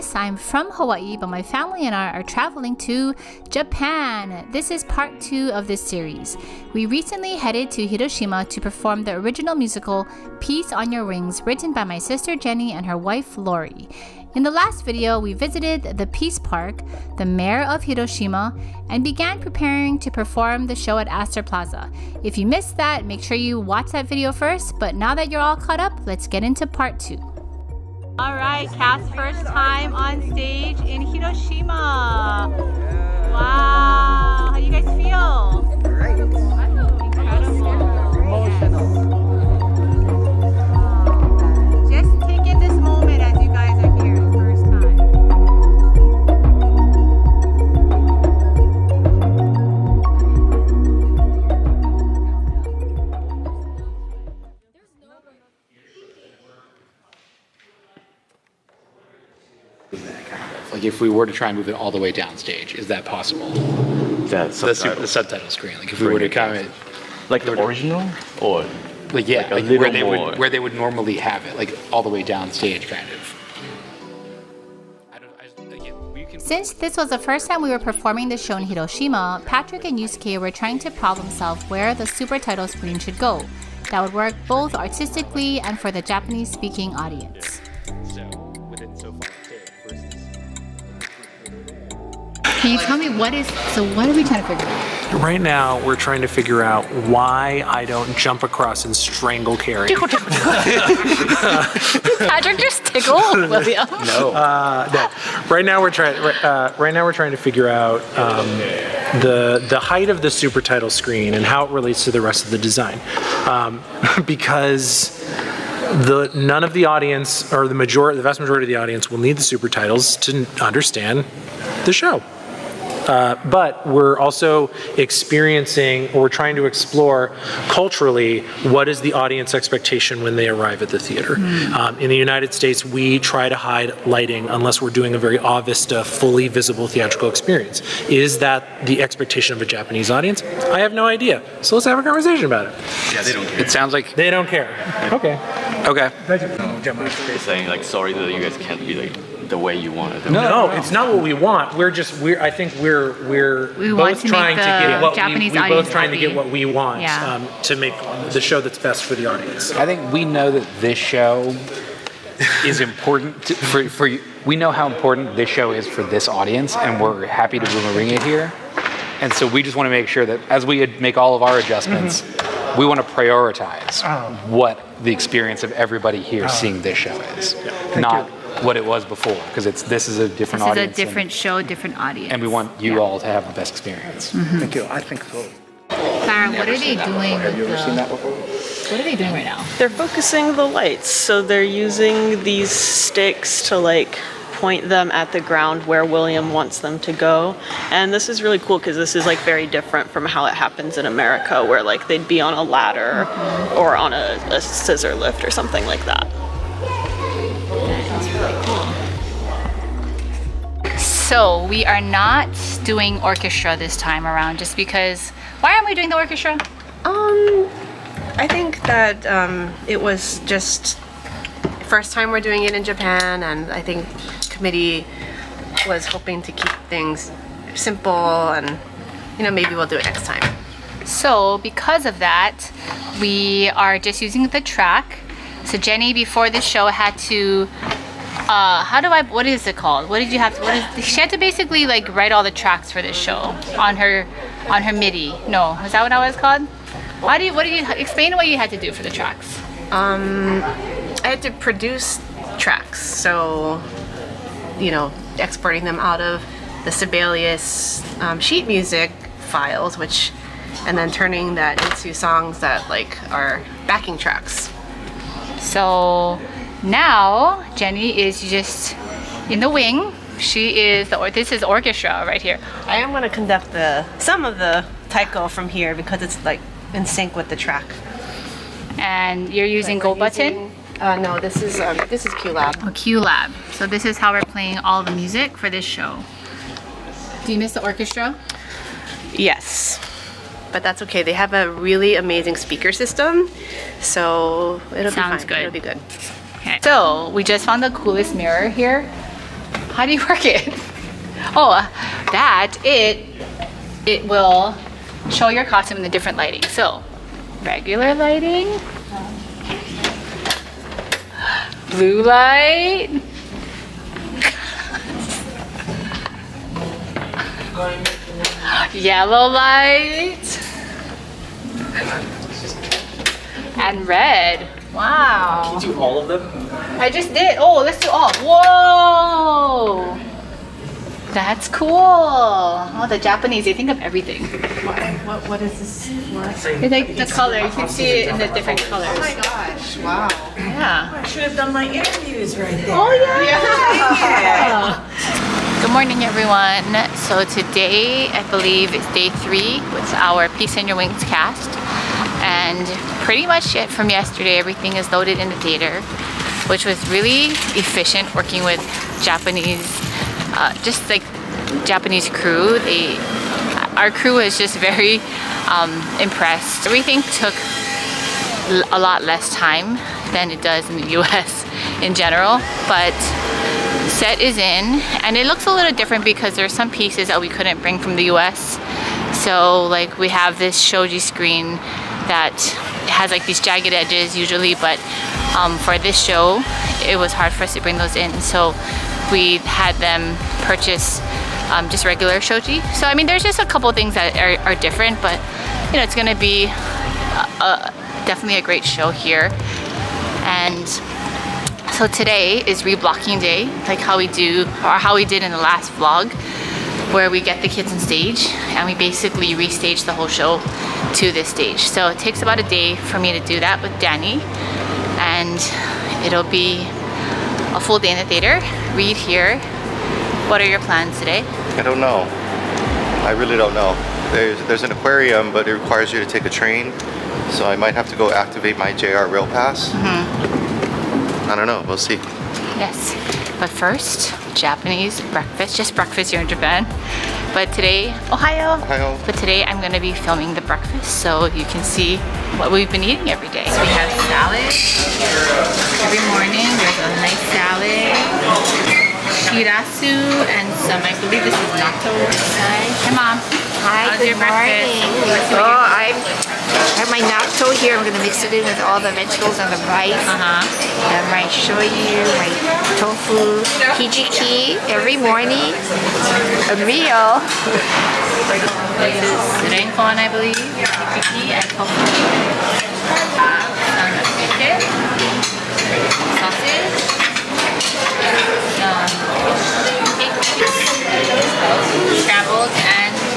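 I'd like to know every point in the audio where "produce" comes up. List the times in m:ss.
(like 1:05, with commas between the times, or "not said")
4:11.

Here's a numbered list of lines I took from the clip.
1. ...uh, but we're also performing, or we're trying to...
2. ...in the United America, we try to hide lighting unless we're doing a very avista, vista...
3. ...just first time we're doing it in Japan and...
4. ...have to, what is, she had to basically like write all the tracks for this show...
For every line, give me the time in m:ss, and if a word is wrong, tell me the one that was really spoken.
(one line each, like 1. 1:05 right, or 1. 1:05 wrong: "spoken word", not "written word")
1. 2:03 wrong: "experiencing", not "performing"
2. 2:11 wrong: "States", not "America"
3. 3:40 right
4. 4:00 right.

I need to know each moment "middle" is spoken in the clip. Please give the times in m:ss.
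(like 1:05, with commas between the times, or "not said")
not said.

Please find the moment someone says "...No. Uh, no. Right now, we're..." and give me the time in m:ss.
1:44.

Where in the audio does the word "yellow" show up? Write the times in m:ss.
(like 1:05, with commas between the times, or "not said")
5:18.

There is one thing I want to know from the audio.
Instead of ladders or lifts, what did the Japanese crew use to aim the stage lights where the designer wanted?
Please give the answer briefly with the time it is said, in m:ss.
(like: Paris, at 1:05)
sticks, at 3:13.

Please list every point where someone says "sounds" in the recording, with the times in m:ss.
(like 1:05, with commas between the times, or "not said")
2:23, 4:55.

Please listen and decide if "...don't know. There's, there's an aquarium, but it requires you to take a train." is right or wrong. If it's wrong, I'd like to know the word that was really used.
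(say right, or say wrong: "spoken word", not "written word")
right.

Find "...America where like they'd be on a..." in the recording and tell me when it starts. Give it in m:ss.
3:21.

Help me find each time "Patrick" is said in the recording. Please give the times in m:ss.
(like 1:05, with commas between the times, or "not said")
1:19, 1:39.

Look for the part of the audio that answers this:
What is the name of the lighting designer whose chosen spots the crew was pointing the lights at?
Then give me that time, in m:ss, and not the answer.
3:16.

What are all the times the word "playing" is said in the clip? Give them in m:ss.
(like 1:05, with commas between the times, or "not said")
4:44.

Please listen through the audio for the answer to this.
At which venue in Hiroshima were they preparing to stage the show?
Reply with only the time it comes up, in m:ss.
0:21.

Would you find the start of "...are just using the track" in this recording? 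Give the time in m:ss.
3:53.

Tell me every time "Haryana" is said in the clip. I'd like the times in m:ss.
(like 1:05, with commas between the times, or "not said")
not said.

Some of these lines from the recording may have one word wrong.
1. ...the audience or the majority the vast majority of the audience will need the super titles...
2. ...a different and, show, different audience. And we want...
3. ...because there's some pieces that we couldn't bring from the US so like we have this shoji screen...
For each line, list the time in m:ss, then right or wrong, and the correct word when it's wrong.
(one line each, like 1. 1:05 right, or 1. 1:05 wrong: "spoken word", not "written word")
1. 1:56 right
2. 3:01 right
3. 6:16 right.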